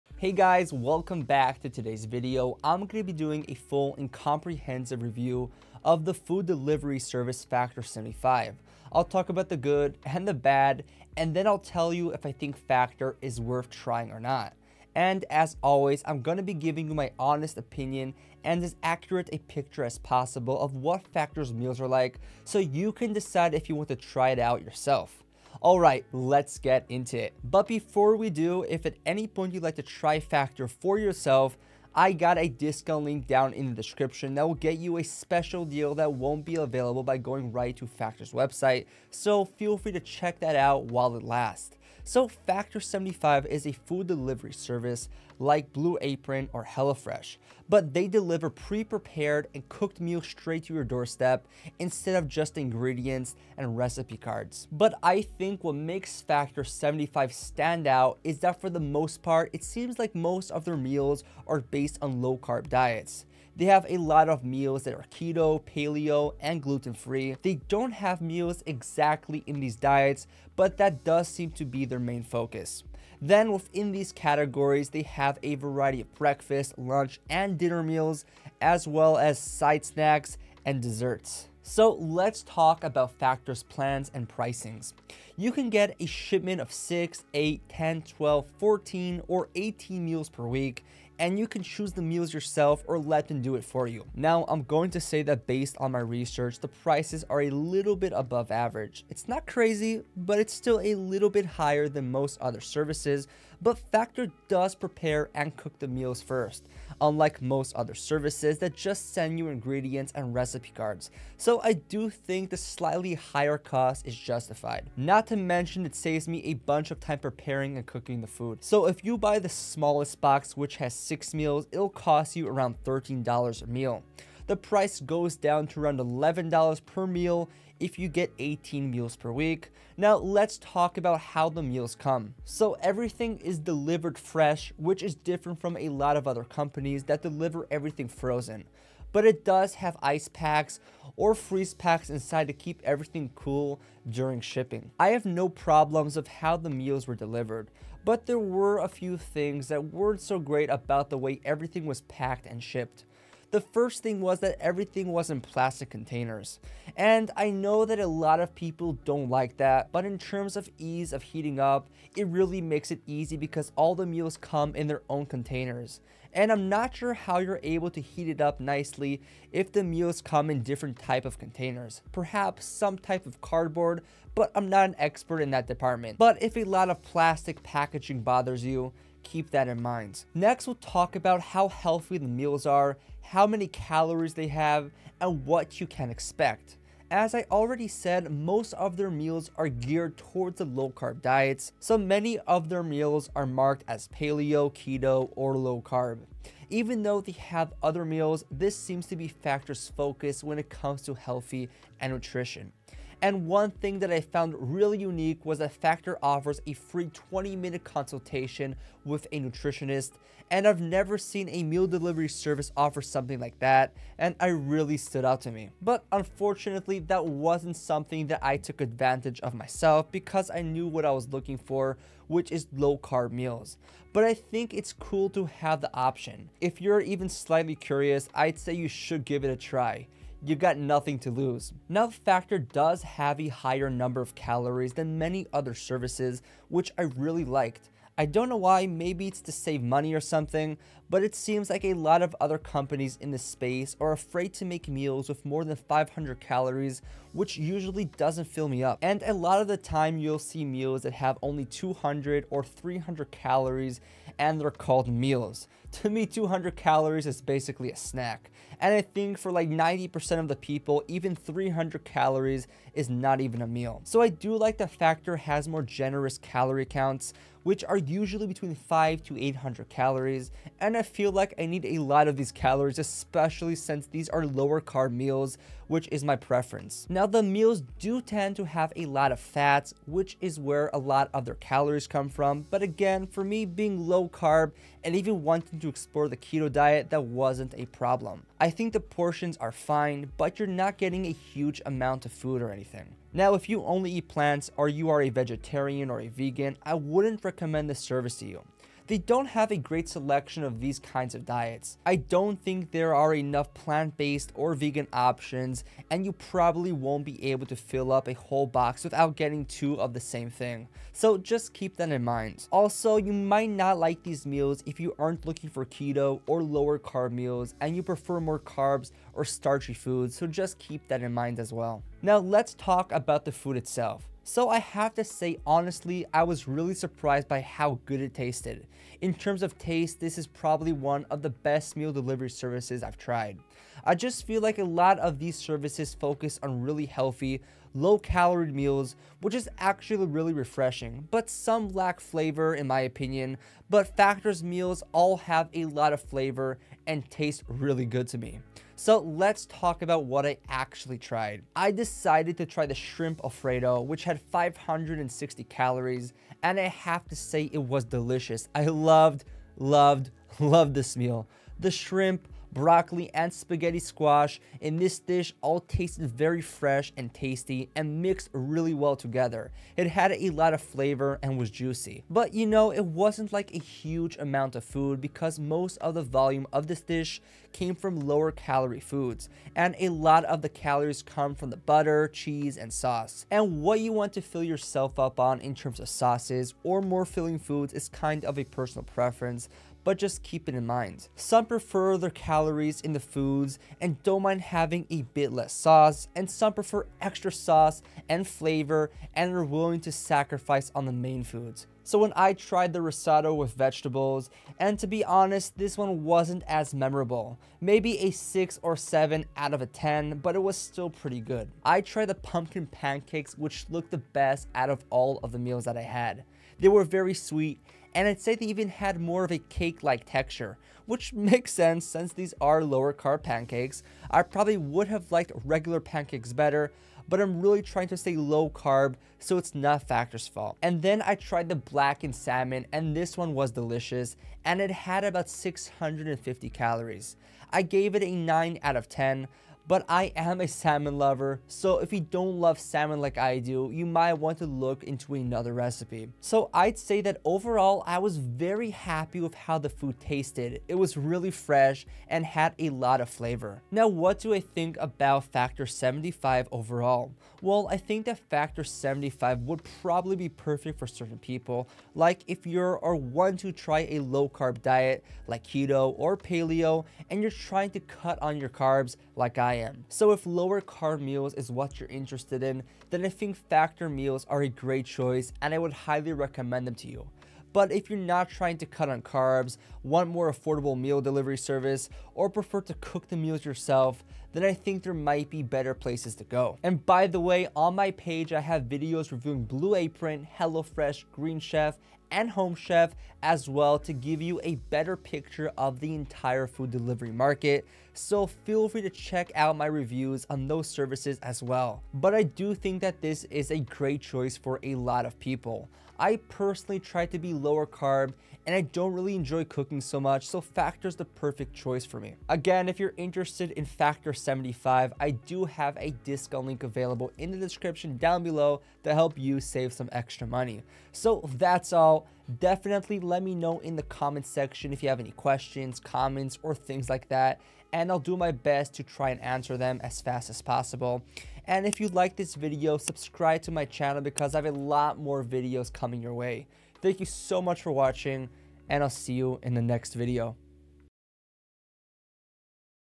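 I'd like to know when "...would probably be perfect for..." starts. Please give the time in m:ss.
7:39.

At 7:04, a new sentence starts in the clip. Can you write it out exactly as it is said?
I probably would have liked regular pancakes better, but I'm really trying to stay low carb so it's not Factor's fault.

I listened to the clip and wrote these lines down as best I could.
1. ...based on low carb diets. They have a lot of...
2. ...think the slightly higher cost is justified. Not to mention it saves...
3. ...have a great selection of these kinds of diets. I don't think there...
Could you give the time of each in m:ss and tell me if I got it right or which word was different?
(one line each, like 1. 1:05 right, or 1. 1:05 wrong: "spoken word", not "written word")
1. 1:01 right
2. 1:52 right
3. 4:59 right.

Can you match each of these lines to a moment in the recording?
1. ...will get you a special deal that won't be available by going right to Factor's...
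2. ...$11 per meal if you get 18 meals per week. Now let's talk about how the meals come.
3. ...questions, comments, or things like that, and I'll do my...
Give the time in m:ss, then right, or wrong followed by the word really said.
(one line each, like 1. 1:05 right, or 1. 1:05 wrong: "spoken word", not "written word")
1. 0:34 right
2. 2:05 right
3. 8:45 right.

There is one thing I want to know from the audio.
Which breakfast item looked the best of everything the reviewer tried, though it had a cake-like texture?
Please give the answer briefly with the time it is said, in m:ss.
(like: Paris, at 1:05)
pumpkin pancakes, at 6:52.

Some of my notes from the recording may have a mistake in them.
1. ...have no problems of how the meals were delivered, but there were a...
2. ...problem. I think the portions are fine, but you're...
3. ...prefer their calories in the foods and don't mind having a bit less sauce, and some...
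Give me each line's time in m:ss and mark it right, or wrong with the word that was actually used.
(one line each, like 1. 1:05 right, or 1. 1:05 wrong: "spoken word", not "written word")
1. 2:25 right
2. 4:47 right
3. 6:31 right.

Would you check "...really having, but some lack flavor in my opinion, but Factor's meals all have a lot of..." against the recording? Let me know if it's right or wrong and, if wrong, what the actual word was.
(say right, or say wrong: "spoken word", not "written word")
wrong: "refreshing", not "having".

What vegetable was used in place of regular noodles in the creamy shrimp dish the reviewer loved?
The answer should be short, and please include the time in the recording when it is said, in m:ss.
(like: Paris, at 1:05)
spaghetti squash, at 6:03.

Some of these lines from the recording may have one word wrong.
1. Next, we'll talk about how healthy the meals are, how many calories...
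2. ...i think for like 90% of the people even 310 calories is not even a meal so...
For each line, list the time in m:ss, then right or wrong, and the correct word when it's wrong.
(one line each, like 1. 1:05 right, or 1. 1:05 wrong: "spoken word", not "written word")
1. 3:00 right
2. 4:18 wrong: "300", not "310".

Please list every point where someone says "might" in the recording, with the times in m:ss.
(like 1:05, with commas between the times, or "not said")
5:13, 7:24, 8:05.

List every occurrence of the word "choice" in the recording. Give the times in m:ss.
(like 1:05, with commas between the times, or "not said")
7:55, 8:24, 8:31.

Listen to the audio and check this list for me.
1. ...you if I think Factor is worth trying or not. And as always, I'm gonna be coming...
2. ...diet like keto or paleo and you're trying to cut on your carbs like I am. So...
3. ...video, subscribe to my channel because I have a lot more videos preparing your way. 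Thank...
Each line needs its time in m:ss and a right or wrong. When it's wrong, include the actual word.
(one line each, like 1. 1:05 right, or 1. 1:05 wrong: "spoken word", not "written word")
1. 0:11 wrong: "giving", not "coming"
2. 7:44 right
3. 8:52 wrong: "coming", not "preparing".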